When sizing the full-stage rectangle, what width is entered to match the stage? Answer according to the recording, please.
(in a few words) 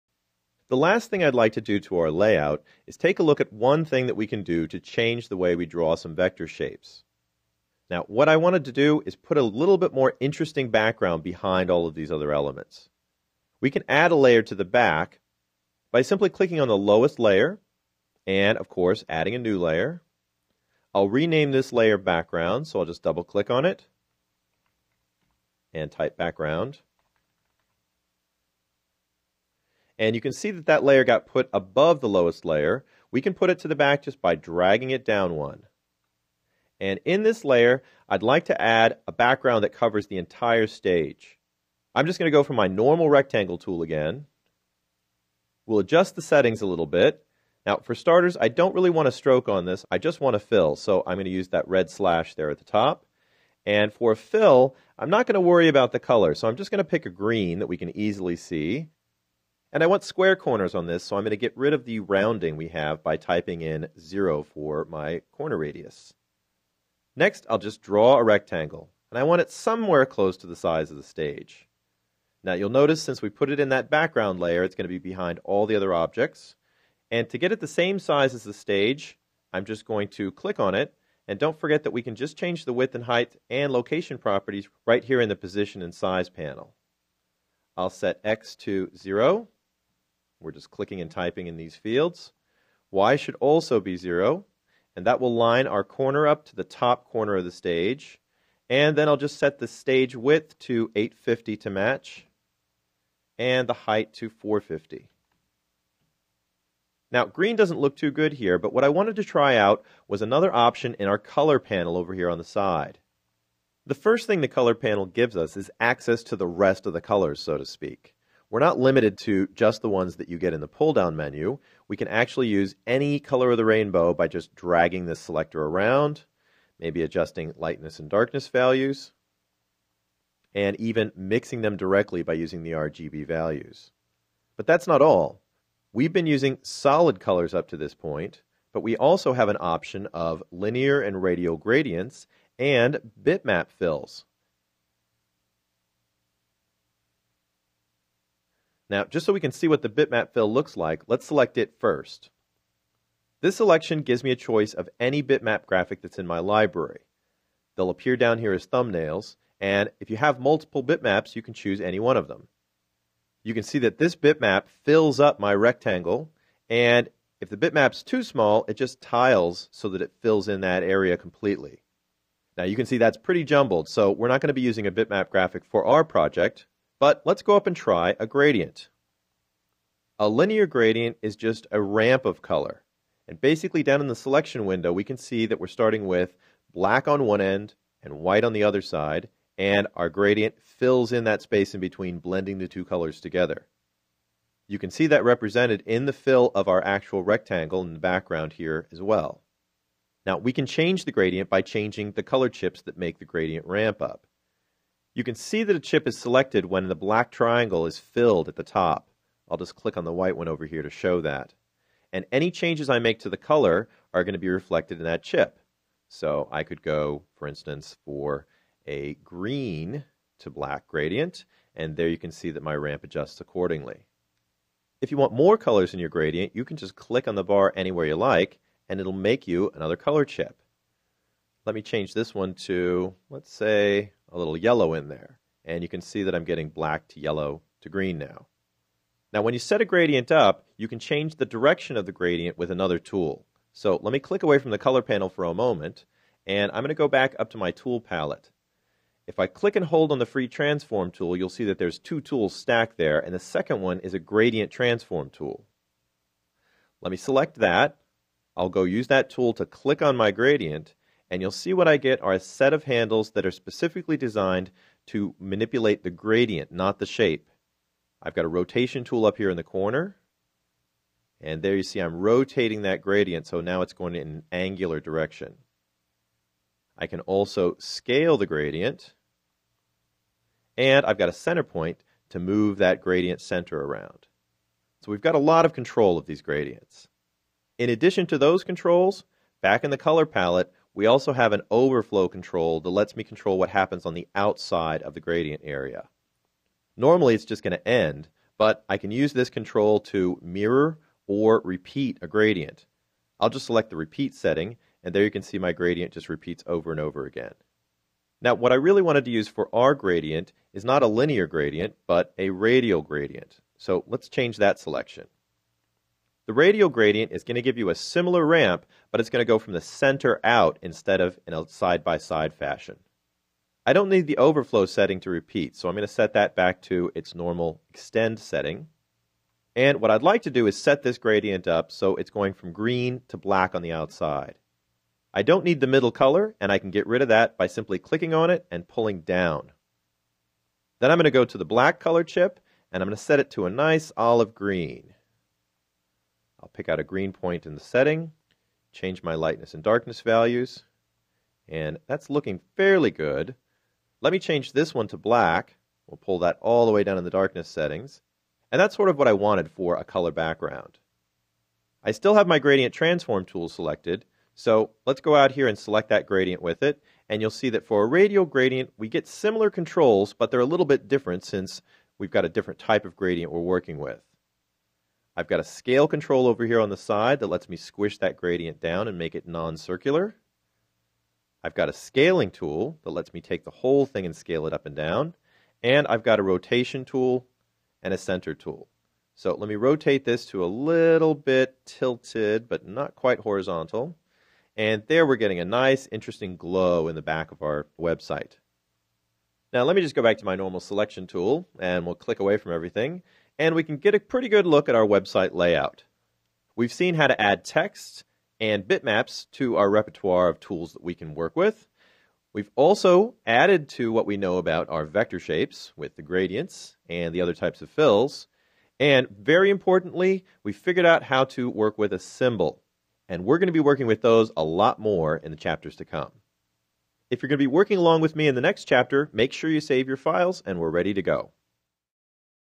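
850.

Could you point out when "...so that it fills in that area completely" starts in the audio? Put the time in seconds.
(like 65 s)
169 s.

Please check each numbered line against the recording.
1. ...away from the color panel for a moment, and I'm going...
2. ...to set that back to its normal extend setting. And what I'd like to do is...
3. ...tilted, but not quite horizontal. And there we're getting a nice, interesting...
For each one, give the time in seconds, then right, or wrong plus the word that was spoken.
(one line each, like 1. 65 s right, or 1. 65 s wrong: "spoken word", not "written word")
1. 244 s right
2. 326 s right
3. 391 s right.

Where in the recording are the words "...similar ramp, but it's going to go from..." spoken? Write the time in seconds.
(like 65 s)
317 s.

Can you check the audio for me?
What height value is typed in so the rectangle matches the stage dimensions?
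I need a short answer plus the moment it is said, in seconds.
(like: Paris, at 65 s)
450, at 104 s.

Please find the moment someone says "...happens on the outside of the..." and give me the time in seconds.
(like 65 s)
293 s.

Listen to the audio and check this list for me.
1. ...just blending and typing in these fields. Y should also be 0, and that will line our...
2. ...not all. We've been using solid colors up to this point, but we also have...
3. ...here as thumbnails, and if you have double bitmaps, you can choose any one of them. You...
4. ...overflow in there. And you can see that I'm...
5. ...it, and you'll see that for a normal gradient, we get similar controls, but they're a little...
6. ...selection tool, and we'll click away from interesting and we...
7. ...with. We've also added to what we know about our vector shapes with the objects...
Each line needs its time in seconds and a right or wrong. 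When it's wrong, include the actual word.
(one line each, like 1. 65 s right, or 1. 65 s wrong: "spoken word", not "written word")
1. 90 s wrong: "clicking", not "blending"
2. 134 s right
3. 158 s wrong: "multiple", not "double"
4. 234 s wrong: "yellow", not "overflow"
5. 366 s wrong: "radial", not "normal"
6. 400 s wrong: "everything", not "interesting"
7. 411 s wrong: "gradients", not "objects".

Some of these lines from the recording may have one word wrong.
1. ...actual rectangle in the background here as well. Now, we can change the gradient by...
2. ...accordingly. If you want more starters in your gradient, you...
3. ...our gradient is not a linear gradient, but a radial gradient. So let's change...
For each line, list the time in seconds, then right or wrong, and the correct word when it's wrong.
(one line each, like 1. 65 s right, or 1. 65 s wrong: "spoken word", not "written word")
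1. 196 s right
2. 223 s wrong: "colors", not "starters"
3. 309 s right.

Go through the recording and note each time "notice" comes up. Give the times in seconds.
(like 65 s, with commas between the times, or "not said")
72 s.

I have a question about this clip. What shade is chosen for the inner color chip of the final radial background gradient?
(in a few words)
olive green.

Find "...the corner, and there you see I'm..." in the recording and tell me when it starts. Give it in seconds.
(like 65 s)
269 s.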